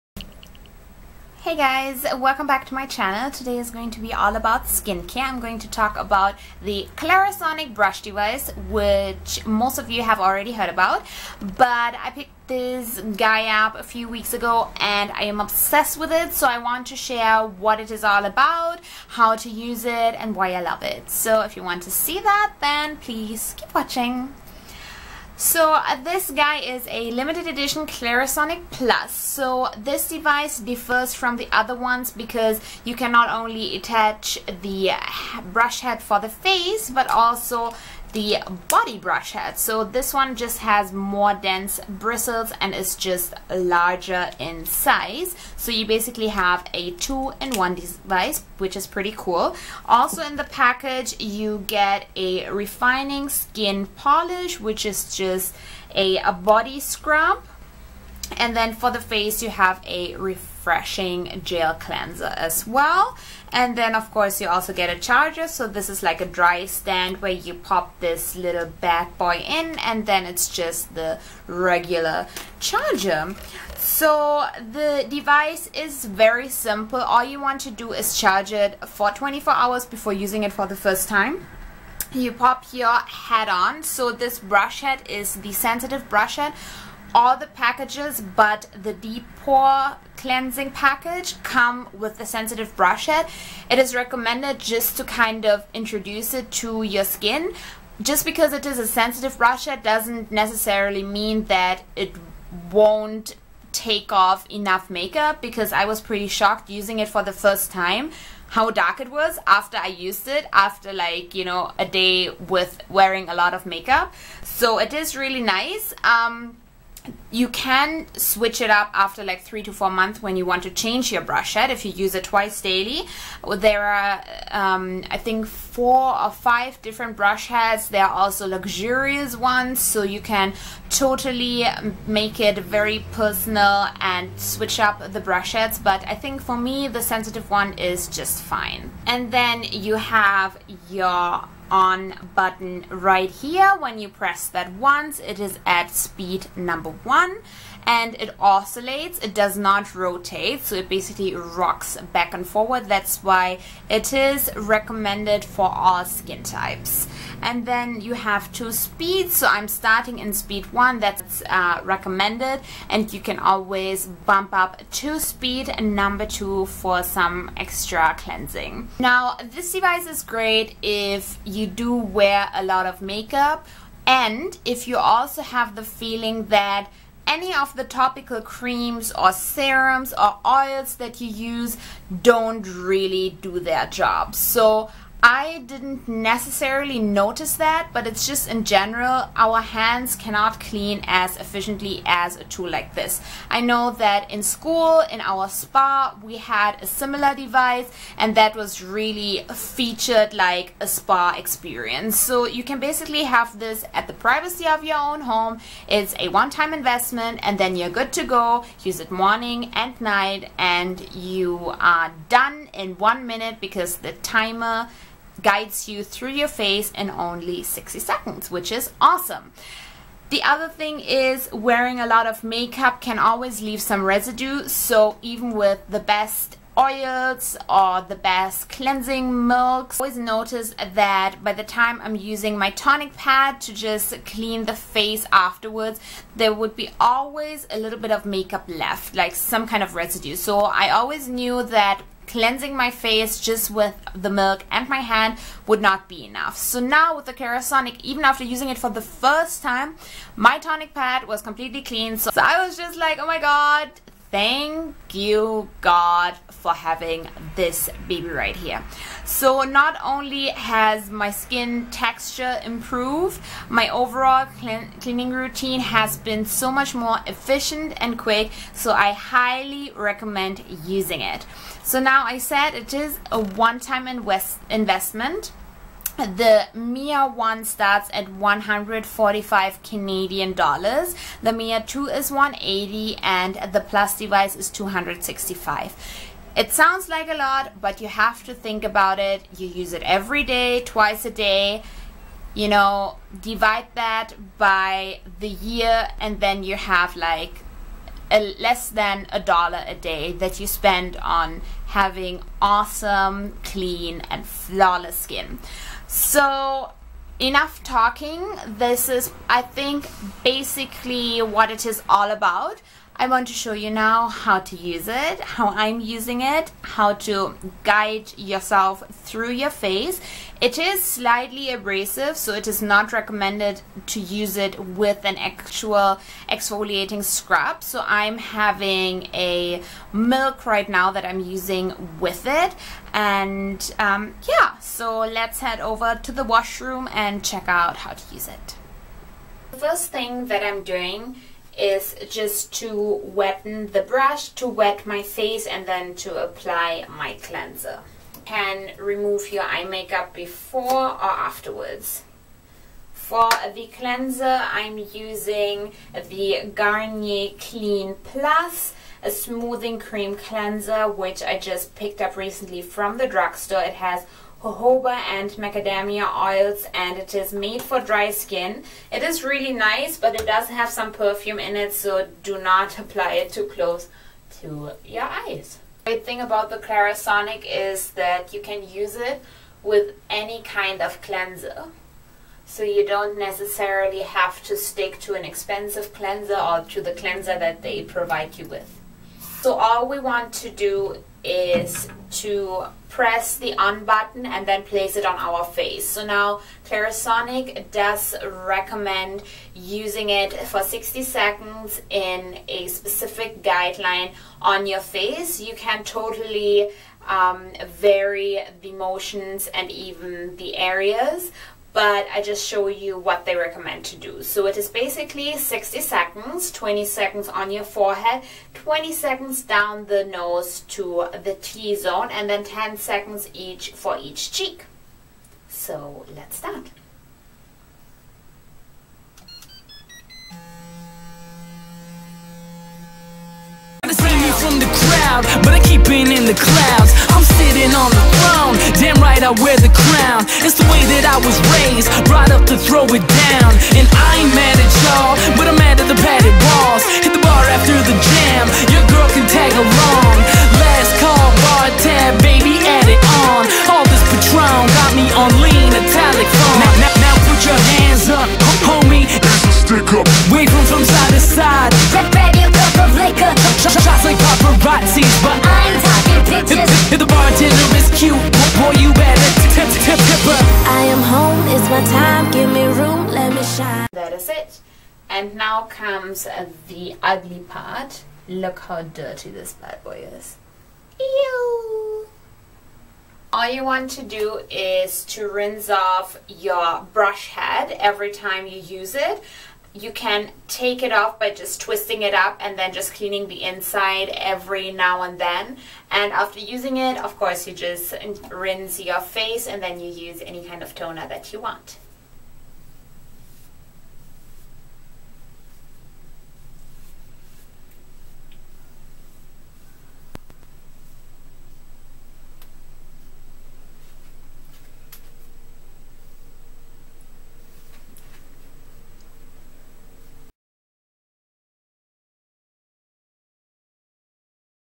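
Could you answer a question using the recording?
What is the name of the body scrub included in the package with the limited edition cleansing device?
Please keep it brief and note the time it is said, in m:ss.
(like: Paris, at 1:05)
Refining skin polish, at 0:52.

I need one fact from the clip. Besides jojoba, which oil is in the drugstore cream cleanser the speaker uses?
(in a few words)
Macadamia.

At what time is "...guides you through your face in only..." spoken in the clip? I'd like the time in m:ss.
3:35.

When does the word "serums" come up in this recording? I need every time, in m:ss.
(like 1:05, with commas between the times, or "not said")
2:59.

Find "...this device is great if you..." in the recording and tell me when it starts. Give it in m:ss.
2:49.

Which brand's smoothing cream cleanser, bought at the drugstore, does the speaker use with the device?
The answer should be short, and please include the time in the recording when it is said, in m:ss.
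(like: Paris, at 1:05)
Garnier, at 5:56.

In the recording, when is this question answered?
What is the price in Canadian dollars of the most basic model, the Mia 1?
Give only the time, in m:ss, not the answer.
4:38.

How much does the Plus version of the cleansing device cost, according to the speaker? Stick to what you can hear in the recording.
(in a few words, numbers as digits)
265.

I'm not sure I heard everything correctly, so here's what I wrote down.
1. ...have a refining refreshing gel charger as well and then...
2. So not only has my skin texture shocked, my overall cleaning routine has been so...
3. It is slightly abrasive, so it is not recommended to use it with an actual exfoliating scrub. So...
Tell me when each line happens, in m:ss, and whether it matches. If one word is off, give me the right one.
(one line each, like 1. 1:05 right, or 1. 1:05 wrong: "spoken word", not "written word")
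1. 0:59 wrong: "cleanser", not "charger"
2. 4:19 wrong: "improved", not "shocked"
3. 5:20 right.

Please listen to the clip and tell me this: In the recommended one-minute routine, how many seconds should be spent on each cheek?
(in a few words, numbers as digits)
10.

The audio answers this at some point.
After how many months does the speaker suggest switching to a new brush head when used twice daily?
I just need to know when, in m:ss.
1:59.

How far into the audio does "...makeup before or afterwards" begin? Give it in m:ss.
5:49.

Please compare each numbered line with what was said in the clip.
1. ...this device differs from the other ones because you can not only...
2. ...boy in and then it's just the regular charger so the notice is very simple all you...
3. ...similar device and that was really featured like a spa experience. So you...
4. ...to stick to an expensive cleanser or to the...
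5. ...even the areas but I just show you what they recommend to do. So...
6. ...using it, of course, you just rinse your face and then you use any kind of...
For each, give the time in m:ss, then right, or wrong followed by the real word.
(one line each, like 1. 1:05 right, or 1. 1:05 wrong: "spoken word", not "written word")
1. 0:29 right
2. 1:09 wrong: "device", not "notice"
3. 3:16 right
4. 6:24 right
5. 6:49 right
6. 8:16 right.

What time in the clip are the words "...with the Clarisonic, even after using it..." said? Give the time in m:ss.
4:07.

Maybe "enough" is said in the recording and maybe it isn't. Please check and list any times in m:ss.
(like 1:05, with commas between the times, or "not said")
1:44, 4:06, 5:07.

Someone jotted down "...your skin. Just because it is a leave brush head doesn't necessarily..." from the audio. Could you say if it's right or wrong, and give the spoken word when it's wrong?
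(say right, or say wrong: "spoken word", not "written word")
wrong: "sensitive", not "leave".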